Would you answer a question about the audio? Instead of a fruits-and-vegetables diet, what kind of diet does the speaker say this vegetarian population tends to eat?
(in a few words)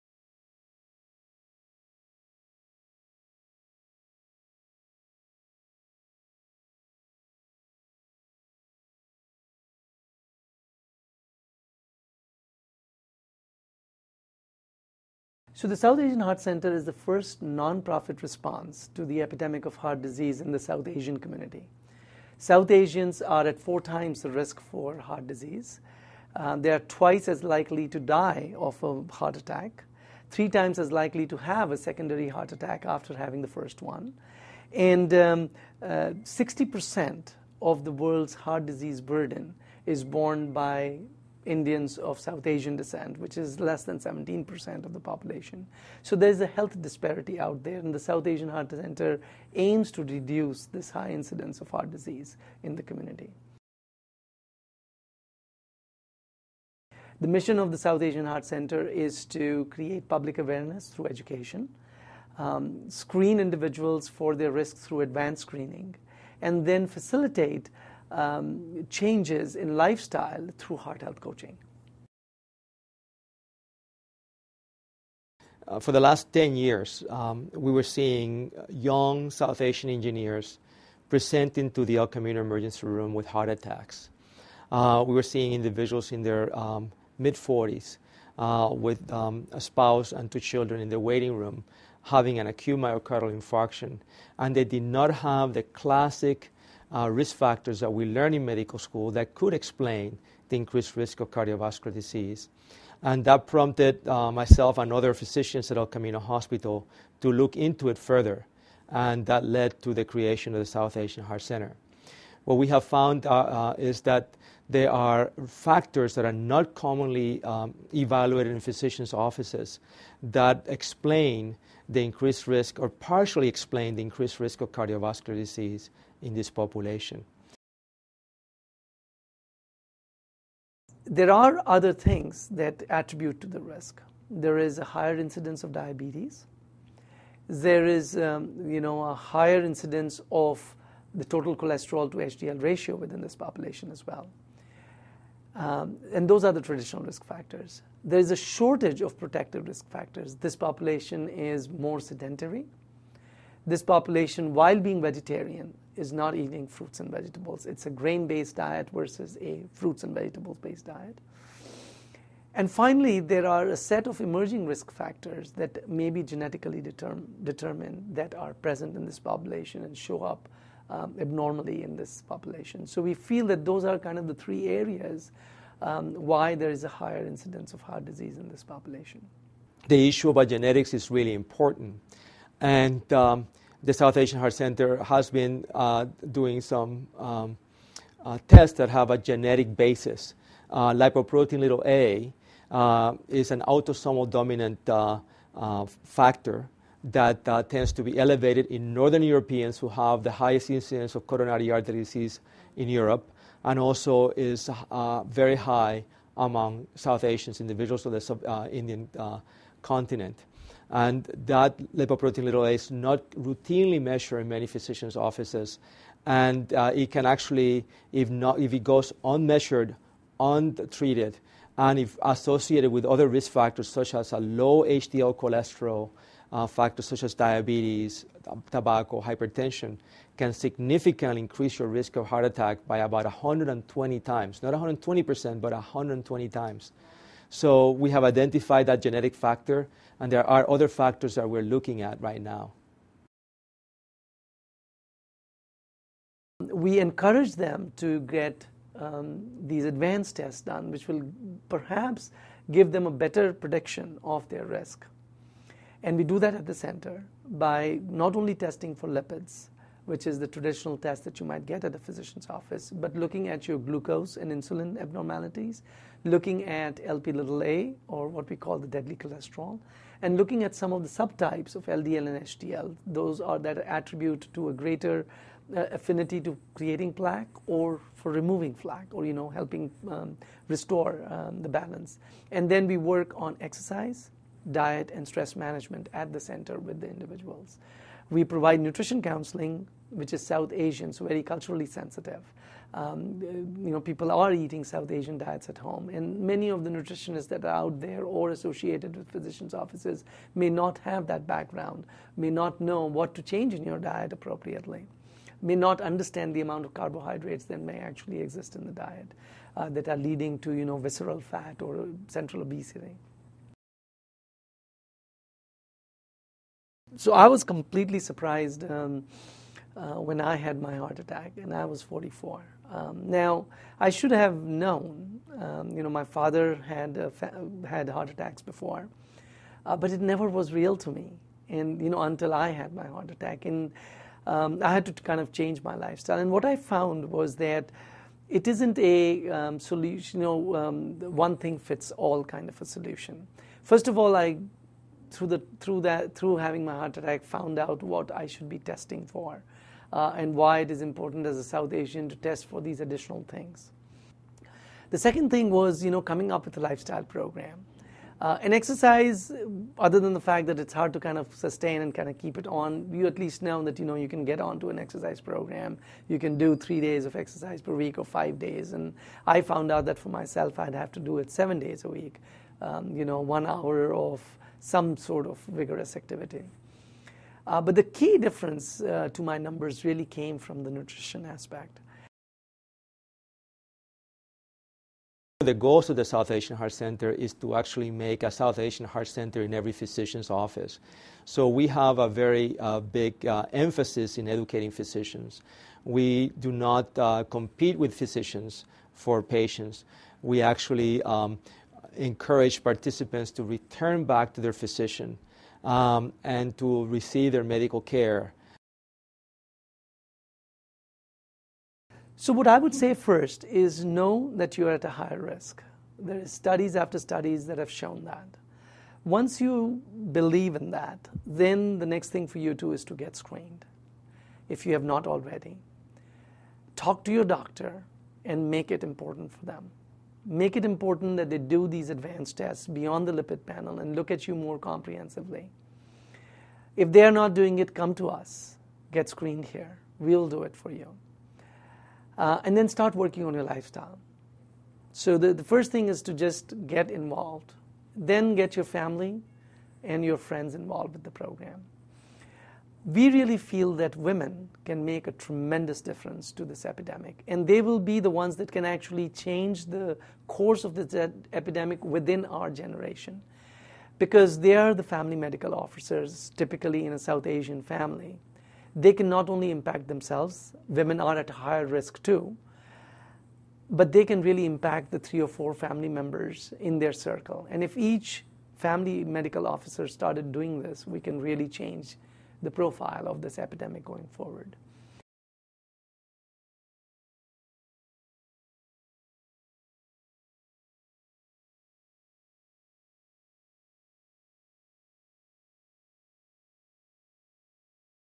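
Grain based.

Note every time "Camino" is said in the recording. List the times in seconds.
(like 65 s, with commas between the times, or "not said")
82 s, 105 s.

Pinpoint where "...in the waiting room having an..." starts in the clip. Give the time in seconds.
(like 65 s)
90 s.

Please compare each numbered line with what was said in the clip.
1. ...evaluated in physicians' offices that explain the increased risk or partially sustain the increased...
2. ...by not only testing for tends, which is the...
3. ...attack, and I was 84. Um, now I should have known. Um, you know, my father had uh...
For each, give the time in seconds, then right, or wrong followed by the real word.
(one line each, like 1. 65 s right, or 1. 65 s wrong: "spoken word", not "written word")
1. 117 s wrong: "explain", not "sustain"
2. 257 s wrong: "lipids", not "tends"
3. 321 s wrong: "44", not "84".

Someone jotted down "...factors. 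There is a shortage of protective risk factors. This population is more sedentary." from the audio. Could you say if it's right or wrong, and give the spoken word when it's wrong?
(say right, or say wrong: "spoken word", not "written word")
right.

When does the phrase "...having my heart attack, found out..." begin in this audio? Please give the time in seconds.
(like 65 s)
346 s.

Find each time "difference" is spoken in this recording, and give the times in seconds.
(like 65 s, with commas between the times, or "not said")
378 s, 456 s.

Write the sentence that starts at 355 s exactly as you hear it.
The second thing was, you know, coming up with a lifestyle program.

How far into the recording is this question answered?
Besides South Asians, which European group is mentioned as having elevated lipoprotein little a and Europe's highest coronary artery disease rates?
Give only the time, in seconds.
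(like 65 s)
198 s.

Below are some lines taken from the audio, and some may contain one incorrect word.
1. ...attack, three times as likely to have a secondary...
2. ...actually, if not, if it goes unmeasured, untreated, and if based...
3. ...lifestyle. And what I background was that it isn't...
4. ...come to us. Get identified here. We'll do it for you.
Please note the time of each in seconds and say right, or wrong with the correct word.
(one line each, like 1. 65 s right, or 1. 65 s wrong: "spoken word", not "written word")
1. 29 s right
2. 217 s wrong: "associated", not "based"
3. 335 s wrong: "found", not "background"
4. 437 s wrong: "screened", not "identified".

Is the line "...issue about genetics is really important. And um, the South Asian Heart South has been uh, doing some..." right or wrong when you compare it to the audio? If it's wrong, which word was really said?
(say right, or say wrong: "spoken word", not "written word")
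wrong: "Center", not "South".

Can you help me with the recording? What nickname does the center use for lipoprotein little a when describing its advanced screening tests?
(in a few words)
The deadly cholesterol.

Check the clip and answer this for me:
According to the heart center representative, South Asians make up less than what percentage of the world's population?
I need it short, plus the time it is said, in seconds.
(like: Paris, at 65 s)
17%, at 43 s.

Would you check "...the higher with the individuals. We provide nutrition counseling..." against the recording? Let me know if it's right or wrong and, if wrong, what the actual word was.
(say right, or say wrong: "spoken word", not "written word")
wrong: "center", not "higher".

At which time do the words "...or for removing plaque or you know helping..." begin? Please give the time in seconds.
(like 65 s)
277 s.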